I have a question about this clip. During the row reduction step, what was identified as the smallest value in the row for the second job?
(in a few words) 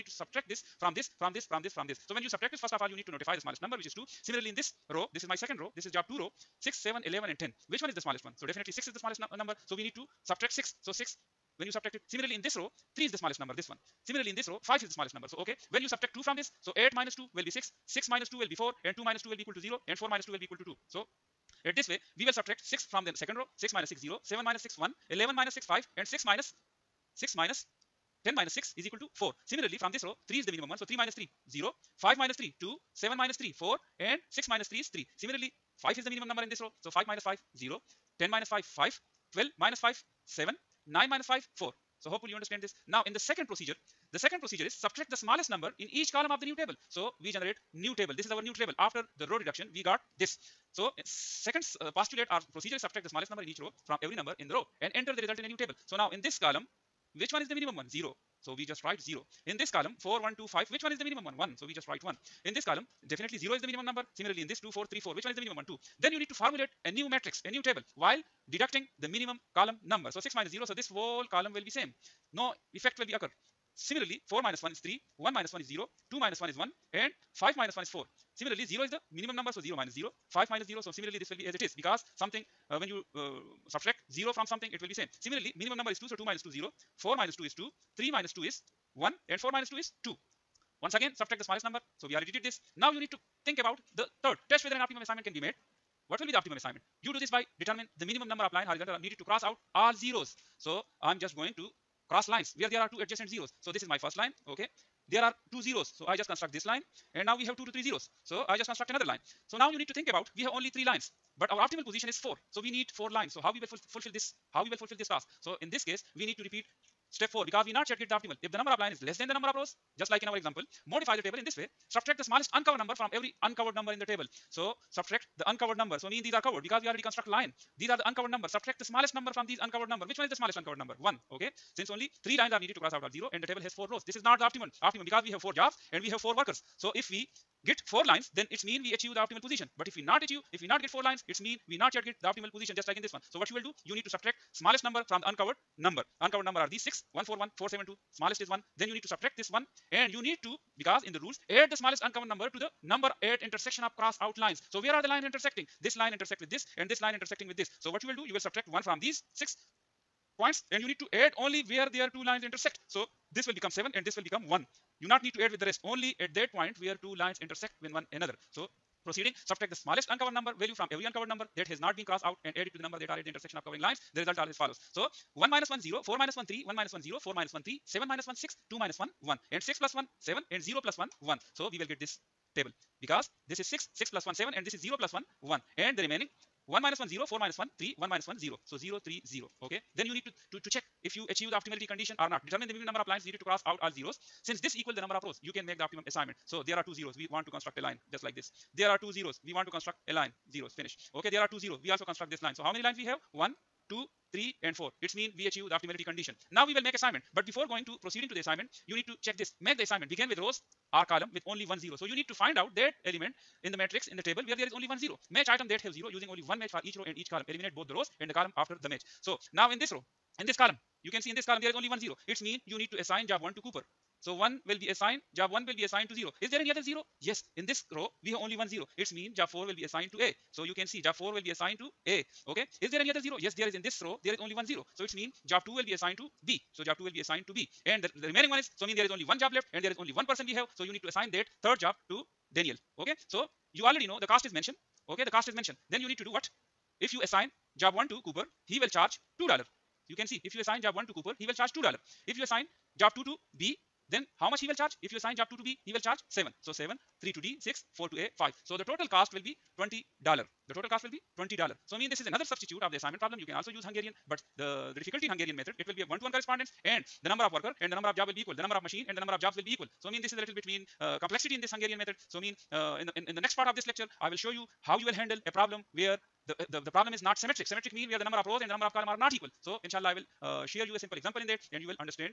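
6.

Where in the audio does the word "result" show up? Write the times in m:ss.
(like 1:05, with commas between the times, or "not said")
0:55, 2:54.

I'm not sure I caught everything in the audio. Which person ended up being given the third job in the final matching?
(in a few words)
Daniel.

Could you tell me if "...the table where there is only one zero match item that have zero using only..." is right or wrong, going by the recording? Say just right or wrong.
right.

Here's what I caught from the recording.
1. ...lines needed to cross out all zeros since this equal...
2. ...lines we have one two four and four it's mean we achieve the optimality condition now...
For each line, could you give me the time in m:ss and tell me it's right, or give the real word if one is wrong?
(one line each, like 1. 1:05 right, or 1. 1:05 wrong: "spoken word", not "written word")
1. 3:13 right
2. 3:22 wrong: "three", not "four".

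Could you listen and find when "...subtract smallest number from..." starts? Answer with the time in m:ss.
2:24.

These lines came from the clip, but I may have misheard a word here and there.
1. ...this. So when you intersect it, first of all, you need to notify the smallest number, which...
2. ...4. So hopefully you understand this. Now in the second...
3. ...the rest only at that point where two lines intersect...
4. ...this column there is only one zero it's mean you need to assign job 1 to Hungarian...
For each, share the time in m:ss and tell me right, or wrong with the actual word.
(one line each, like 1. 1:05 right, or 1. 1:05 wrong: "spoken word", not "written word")
1. 0:01 wrong: "subtract", not "intersect"
2. 0:41 right
3. 2:45 right
4. 3:41 wrong: "Cooper", not "Hungarian".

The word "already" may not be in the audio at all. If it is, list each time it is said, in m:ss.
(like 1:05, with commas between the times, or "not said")
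1:32, 2:06, 4:03.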